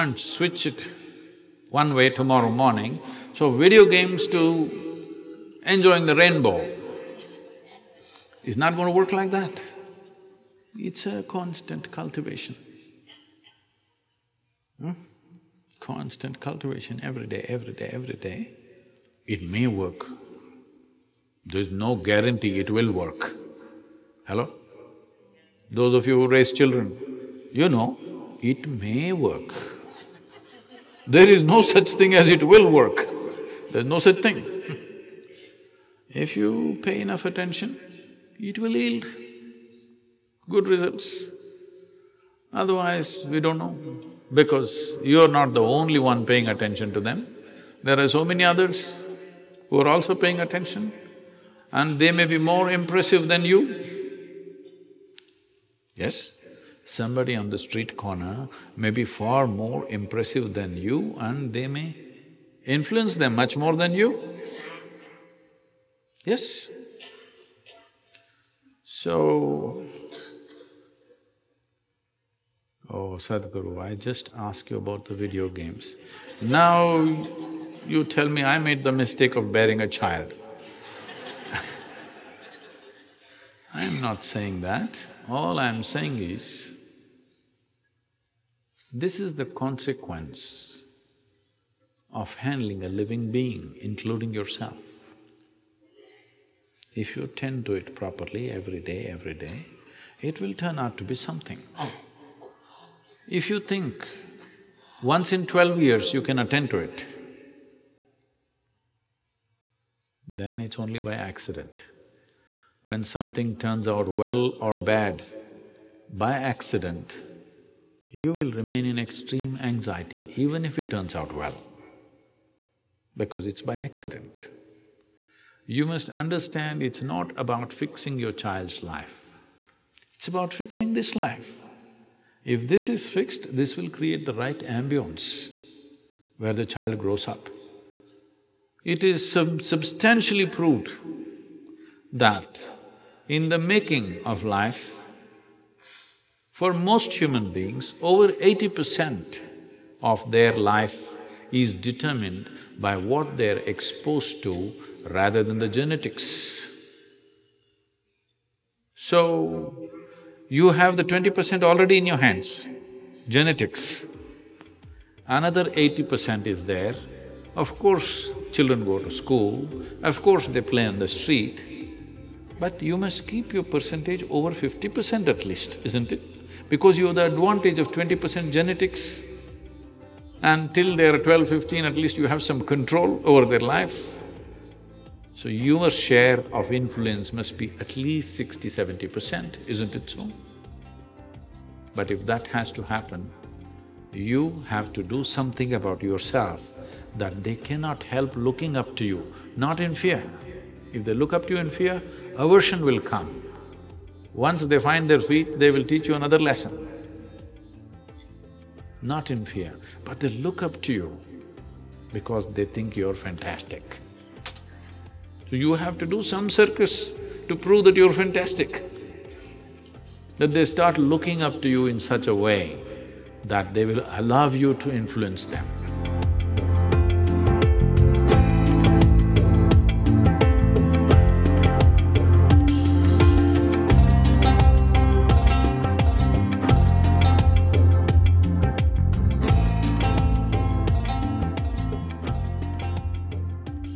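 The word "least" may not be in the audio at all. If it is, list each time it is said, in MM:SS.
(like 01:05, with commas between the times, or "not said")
02:55, 03:01, 03:07.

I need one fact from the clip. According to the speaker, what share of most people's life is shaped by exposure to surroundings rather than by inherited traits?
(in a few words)
over 80 percent.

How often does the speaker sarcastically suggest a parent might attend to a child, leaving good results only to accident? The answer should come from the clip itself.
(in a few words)
once in 12 years.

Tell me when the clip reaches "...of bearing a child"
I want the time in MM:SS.
01:19.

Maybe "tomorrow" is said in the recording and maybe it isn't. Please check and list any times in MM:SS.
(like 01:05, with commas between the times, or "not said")
00:02.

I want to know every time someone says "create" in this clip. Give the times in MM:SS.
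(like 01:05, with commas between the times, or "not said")
02:13.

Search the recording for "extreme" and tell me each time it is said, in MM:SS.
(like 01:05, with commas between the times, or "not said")
01:59.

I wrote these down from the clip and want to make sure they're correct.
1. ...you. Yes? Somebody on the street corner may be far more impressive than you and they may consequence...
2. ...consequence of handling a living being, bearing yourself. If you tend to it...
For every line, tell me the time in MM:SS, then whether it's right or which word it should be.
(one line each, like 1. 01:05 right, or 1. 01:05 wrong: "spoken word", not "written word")
1. 00:53 wrong: "influence", not "consequence"
2. 01:29 wrong: "including", not "bearing".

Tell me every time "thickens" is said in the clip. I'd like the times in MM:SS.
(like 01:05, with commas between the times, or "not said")
not said.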